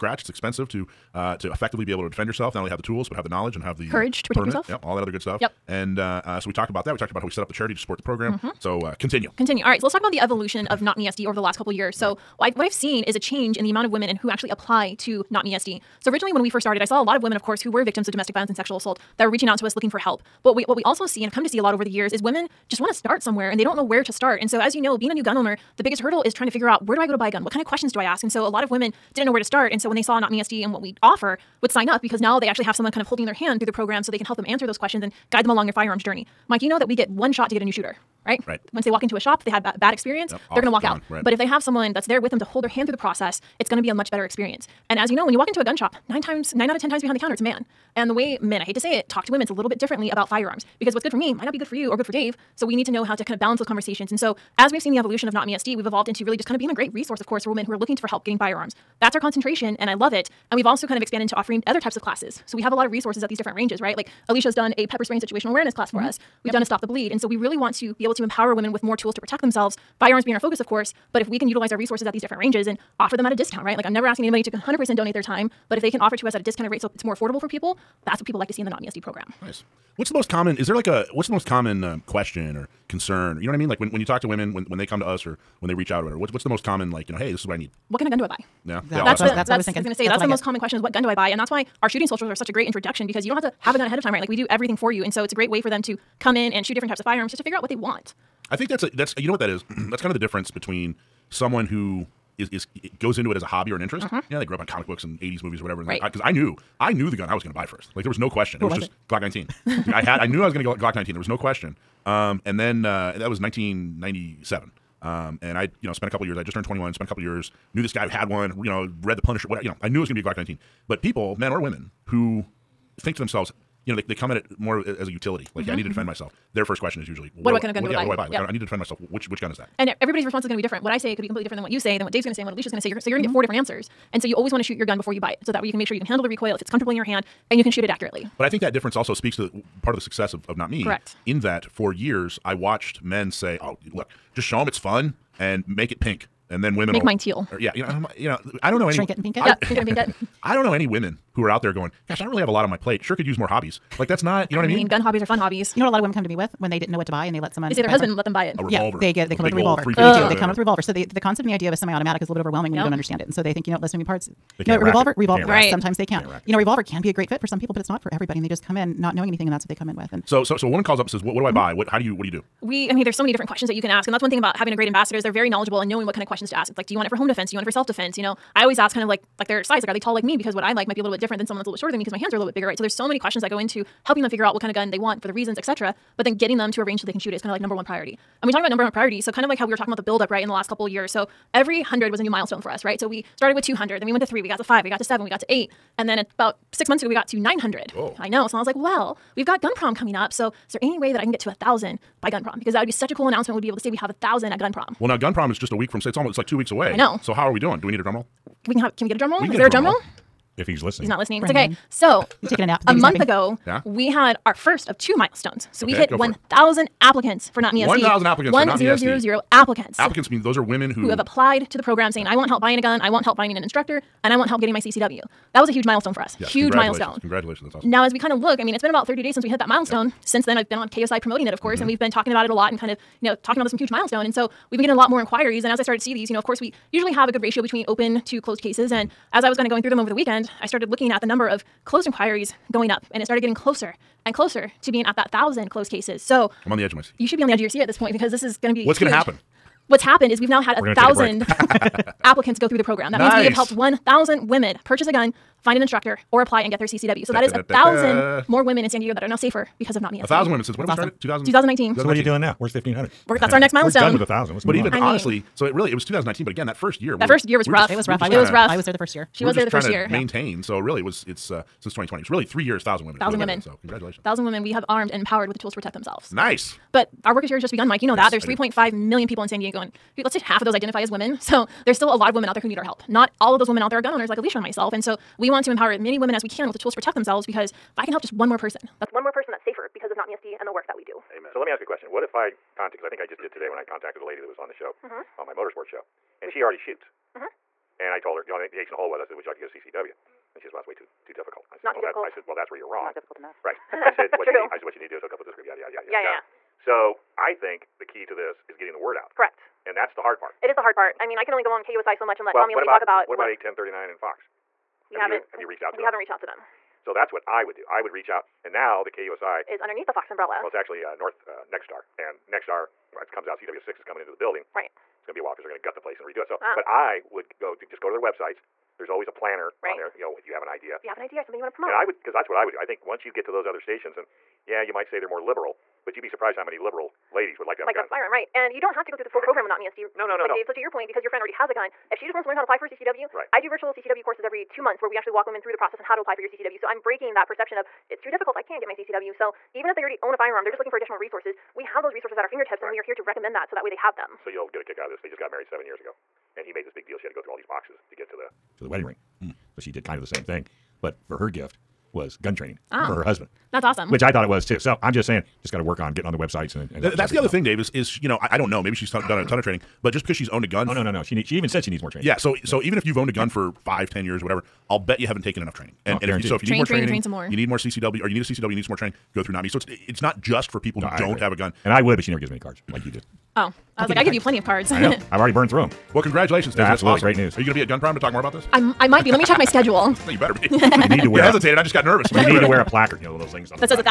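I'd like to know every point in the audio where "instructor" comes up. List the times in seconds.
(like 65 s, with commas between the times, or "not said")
223 s, 255 s.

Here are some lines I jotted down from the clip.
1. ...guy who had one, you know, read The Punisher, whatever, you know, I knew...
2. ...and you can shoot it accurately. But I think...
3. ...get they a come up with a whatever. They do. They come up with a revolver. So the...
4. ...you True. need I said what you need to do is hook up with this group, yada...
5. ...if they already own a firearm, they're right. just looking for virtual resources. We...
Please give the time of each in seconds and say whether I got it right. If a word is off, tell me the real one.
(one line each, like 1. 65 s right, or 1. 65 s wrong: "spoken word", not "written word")
1. 117 s right
2. 137 s right
3. 159 s wrong: "revolver", not "whatever"
4. 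304 s right
5. 349 s wrong: "additional", not "virtual".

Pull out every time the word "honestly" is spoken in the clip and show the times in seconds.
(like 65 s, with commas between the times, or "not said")
264 s.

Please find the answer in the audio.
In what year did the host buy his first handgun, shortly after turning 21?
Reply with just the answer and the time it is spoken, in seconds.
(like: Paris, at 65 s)
1997, at 113 s.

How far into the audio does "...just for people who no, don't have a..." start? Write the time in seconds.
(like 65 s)
380 s.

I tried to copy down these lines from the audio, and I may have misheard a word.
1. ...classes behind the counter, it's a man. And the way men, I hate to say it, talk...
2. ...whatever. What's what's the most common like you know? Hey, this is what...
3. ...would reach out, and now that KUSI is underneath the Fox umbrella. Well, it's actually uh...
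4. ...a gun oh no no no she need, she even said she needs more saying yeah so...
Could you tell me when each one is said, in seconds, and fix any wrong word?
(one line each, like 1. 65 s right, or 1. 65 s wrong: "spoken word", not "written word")
1. 46 s wrong: "times", not "classes"
2. 86 s right
3. 318 s right
4. 370 s wrong: "training", not "saying".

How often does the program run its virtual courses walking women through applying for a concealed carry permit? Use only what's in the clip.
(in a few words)
Every 2 months.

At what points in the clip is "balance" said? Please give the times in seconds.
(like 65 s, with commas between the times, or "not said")
53 s.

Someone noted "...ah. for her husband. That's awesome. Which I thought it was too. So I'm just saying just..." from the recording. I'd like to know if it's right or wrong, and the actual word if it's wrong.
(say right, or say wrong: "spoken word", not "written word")
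right.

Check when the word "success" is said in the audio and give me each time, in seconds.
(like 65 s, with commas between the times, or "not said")
140 s.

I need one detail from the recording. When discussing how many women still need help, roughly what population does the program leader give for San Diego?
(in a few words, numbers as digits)
3.5 million.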